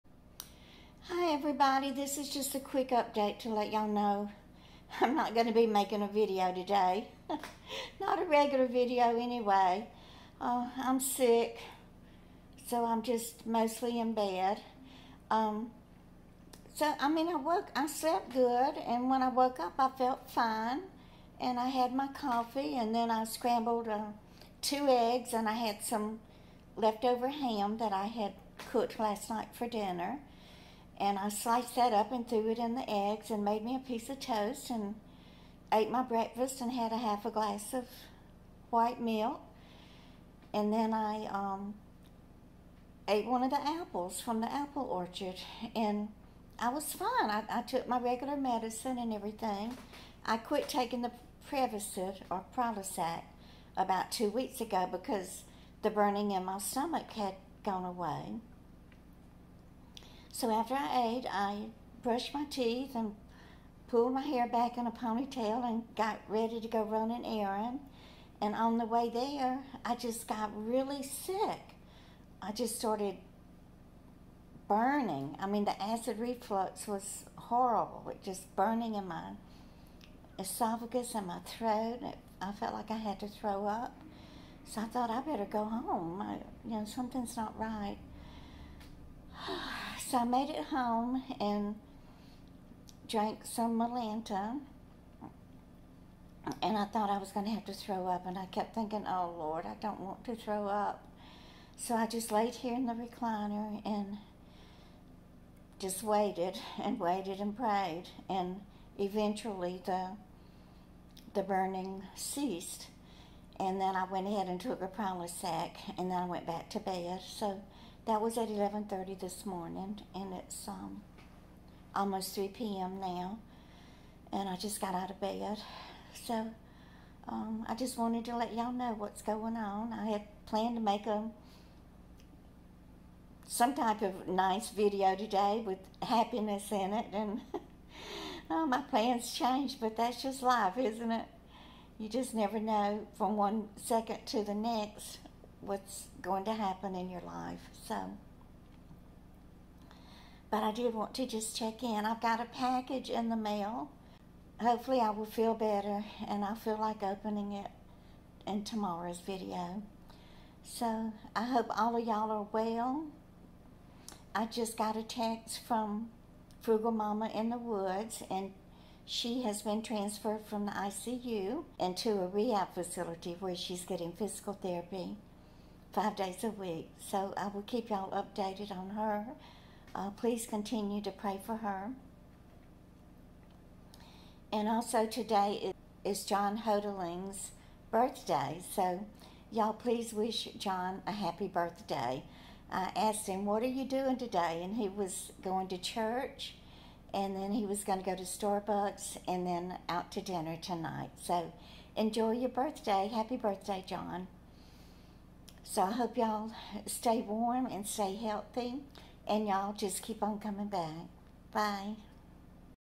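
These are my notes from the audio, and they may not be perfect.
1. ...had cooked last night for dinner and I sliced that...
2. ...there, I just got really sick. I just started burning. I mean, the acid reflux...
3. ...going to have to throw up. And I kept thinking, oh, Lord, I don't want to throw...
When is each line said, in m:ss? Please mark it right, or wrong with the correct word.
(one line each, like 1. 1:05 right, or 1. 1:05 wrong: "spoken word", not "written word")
1. 0:28 right
2. 1:09 right
3. 1:37 right.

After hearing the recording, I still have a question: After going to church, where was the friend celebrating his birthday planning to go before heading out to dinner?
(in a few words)
Starbucks.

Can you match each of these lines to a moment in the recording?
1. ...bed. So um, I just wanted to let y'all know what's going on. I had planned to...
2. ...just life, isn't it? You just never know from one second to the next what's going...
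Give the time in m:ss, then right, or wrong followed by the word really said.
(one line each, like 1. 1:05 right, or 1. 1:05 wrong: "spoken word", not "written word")
1. 2:05 right
2. 2:20 right.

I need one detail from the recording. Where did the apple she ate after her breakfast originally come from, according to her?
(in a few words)
The apple orchard.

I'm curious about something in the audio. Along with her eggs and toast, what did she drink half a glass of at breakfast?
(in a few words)
White milk.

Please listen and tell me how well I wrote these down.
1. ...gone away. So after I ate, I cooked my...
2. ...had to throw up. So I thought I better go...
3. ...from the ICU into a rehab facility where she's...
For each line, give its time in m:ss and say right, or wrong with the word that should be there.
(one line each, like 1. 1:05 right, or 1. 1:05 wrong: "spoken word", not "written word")
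1. 0:57 wrong: "brushed", not "cooked"
2. 1:22 right
3. 2:50 right.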